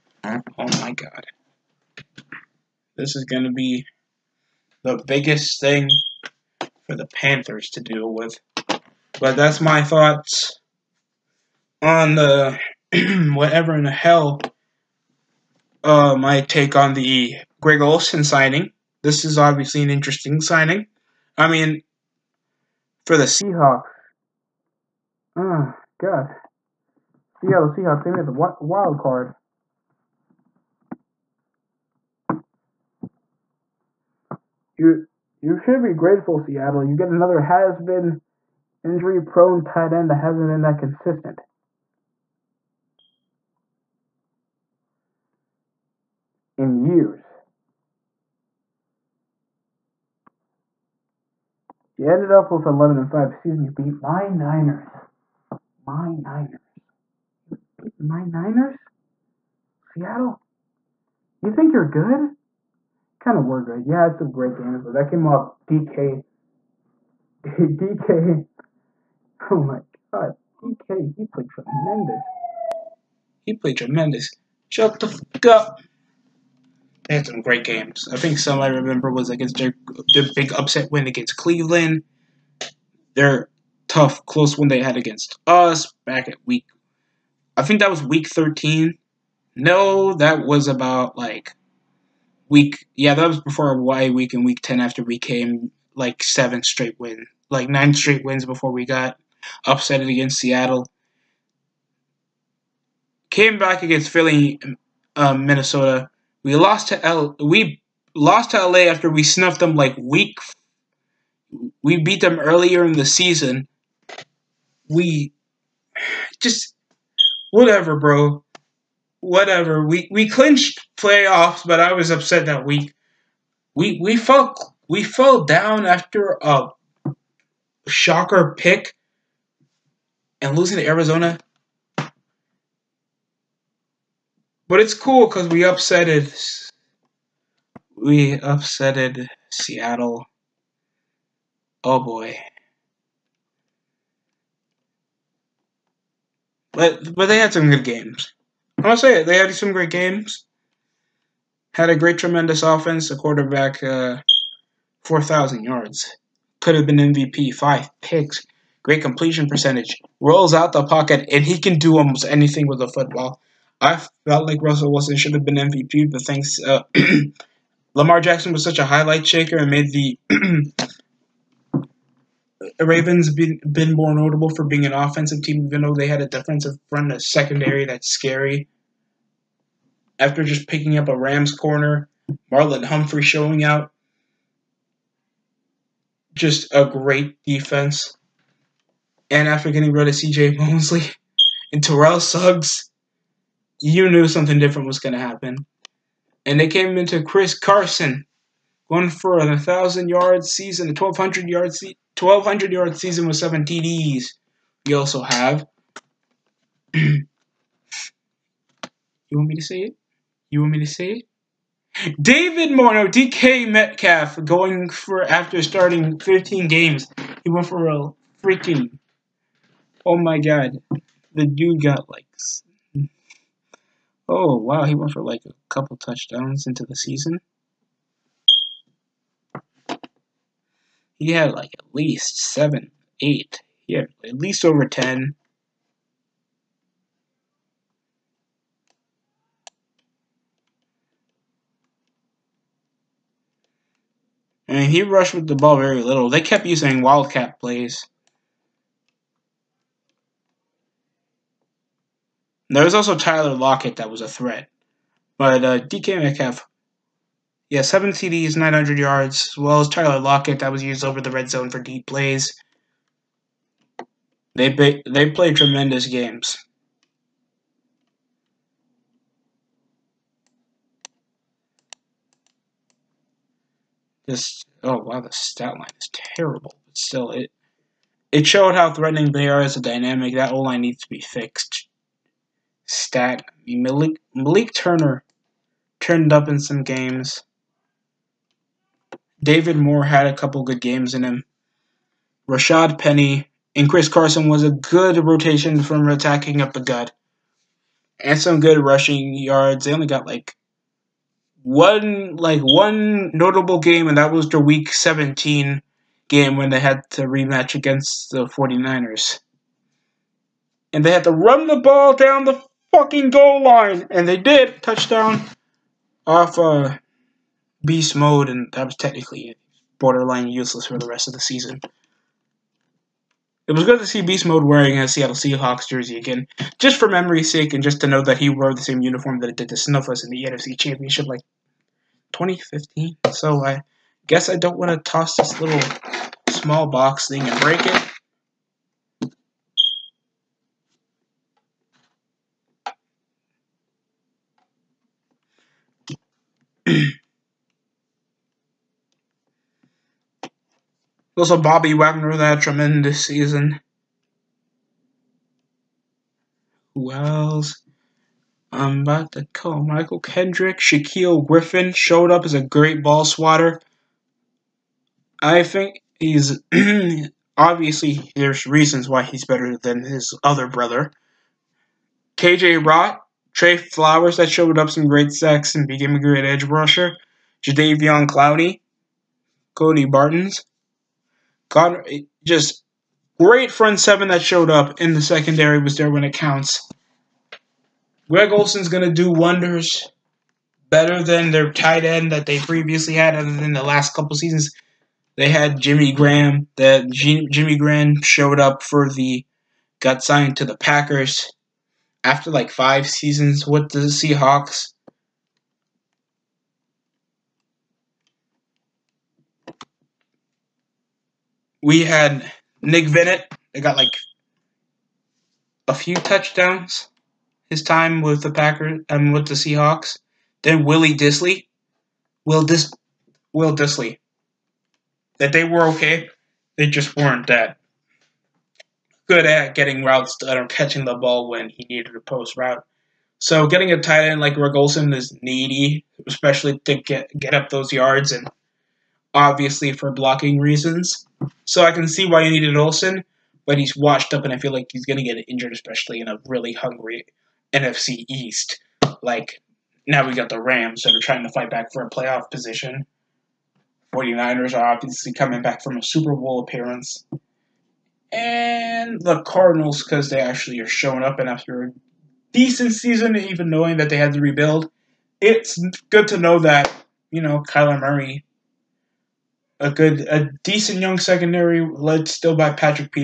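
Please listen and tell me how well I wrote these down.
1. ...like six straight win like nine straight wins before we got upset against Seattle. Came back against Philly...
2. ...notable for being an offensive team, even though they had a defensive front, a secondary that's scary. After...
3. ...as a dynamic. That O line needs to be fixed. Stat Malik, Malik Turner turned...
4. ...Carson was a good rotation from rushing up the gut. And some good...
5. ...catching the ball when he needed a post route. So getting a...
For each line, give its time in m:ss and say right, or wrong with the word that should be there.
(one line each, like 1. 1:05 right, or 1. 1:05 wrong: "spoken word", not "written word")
1. 1:35 wrong: "seven", not "six"
2. 2:54 right
3. 4:39 right
4. 4:54 wrong: "attacking", not "rushing"
5. 7:10 right.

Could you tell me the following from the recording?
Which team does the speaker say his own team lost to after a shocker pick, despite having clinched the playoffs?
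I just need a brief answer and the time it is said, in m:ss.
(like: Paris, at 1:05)
Arizona, at 2:10.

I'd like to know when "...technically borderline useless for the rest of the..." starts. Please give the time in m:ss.
5:18.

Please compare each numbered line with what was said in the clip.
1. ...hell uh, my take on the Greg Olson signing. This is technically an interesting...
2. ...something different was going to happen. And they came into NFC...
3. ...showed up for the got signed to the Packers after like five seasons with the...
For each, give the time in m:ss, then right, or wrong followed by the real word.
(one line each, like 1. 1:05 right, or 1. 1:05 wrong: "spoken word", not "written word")
1. 0:13 wrong: "obviously", not "technically"
2. 3:14 wrong: "Chris", not "NFC"
3. 6:38 right.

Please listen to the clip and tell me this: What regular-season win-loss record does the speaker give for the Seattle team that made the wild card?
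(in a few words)
11 and 5.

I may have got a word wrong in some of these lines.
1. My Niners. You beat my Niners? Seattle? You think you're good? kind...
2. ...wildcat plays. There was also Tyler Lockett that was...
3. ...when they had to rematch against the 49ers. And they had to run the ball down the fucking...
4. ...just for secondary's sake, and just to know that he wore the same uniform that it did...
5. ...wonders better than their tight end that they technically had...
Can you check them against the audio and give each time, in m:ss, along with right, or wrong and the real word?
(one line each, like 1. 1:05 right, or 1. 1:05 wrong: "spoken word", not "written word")
1. 0:55 right
2. 4:07 right
3. 5:06 right
4. 5:26 wrong: "memory", not "secondary"
5. 6:29 wrong: "previously", not "technically".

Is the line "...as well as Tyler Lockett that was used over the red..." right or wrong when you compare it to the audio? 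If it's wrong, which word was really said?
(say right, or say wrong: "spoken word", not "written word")
right.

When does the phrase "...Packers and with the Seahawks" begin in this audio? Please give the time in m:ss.
6:58.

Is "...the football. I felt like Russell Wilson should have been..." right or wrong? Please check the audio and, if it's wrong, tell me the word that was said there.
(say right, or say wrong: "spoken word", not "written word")
right.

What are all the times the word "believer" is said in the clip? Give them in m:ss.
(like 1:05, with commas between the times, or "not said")
not said.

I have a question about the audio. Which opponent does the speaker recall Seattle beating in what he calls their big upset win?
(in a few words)
Cleveland.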